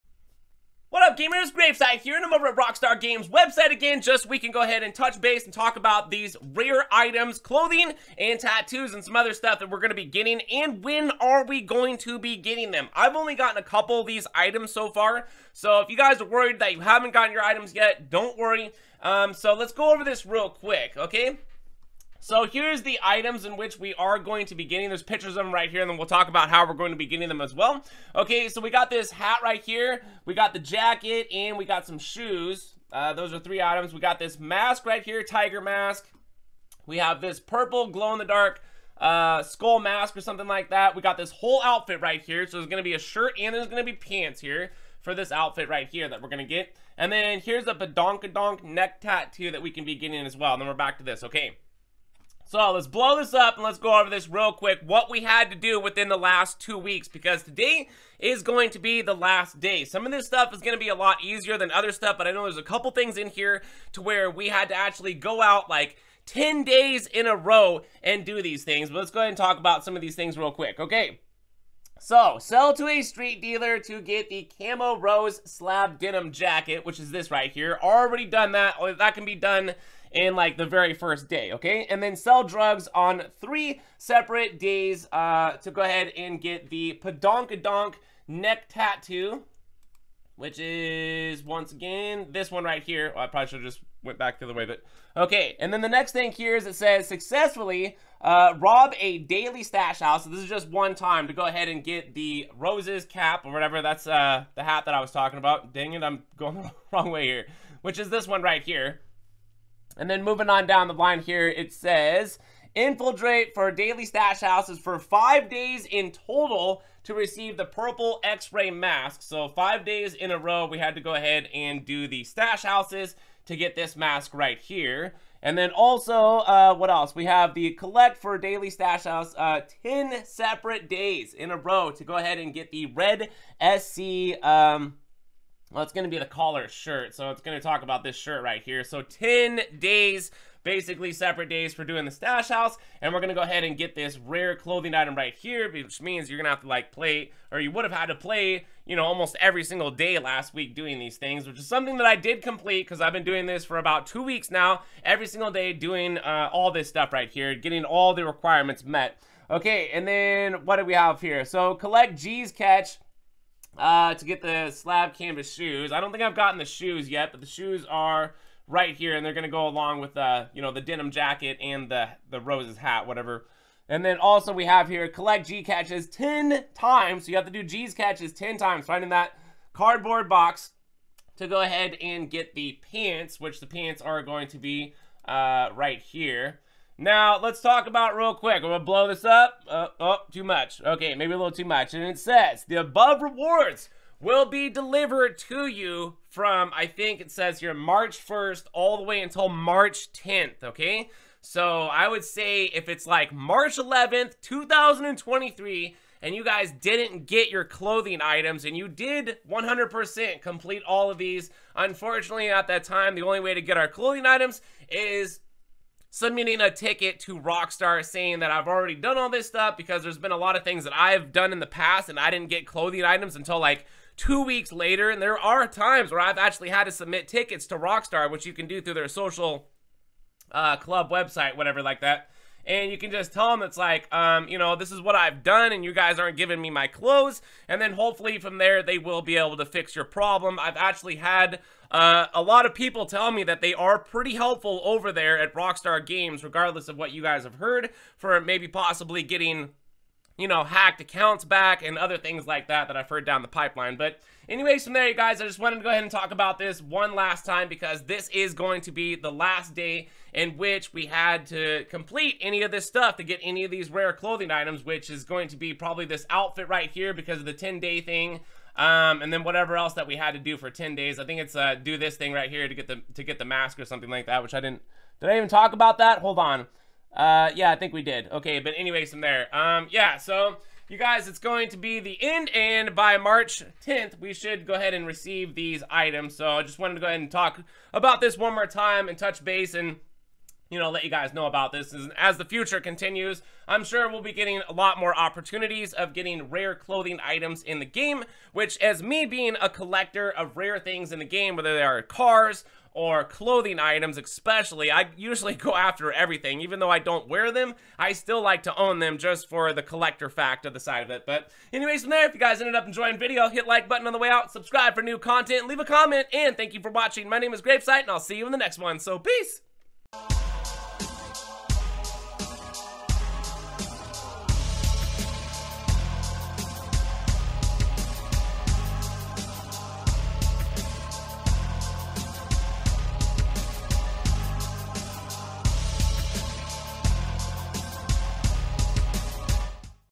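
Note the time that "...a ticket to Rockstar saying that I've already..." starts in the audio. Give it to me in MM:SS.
03:36.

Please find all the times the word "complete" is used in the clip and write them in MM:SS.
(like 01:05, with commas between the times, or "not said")
02:32, 03:30, 04:21.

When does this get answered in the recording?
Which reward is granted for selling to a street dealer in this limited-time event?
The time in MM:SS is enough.
01:14.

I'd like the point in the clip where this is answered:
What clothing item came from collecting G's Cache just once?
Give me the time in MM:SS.
02:44.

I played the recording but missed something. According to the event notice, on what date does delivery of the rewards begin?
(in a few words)
March 1st.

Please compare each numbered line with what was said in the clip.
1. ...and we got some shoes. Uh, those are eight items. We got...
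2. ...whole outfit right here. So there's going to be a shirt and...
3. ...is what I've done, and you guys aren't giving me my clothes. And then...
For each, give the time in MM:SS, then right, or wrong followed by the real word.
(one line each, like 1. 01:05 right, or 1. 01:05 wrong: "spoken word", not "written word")
1. 00:31 wrong: "three", not "eight"
2. 00:41 right
3. 03:54 right.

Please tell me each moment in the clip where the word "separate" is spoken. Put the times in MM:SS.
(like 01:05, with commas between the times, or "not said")
01:23, 02:10, 02:21.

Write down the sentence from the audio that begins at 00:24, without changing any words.
There's pictures of them right here, and then we'll talk about how we're going to be getting them as well.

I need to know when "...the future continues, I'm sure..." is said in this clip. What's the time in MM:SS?
04:52.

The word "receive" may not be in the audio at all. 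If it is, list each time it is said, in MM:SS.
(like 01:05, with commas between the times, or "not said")
01:57, 04:45.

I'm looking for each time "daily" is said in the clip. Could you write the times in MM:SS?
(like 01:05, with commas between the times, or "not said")
01:39, 01:53, 02:08.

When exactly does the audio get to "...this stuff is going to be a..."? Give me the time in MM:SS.
01:00.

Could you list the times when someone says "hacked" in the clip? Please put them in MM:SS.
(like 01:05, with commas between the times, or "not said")
04:10.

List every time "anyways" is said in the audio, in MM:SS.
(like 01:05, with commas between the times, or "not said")
04:14, 04:38, 05:11.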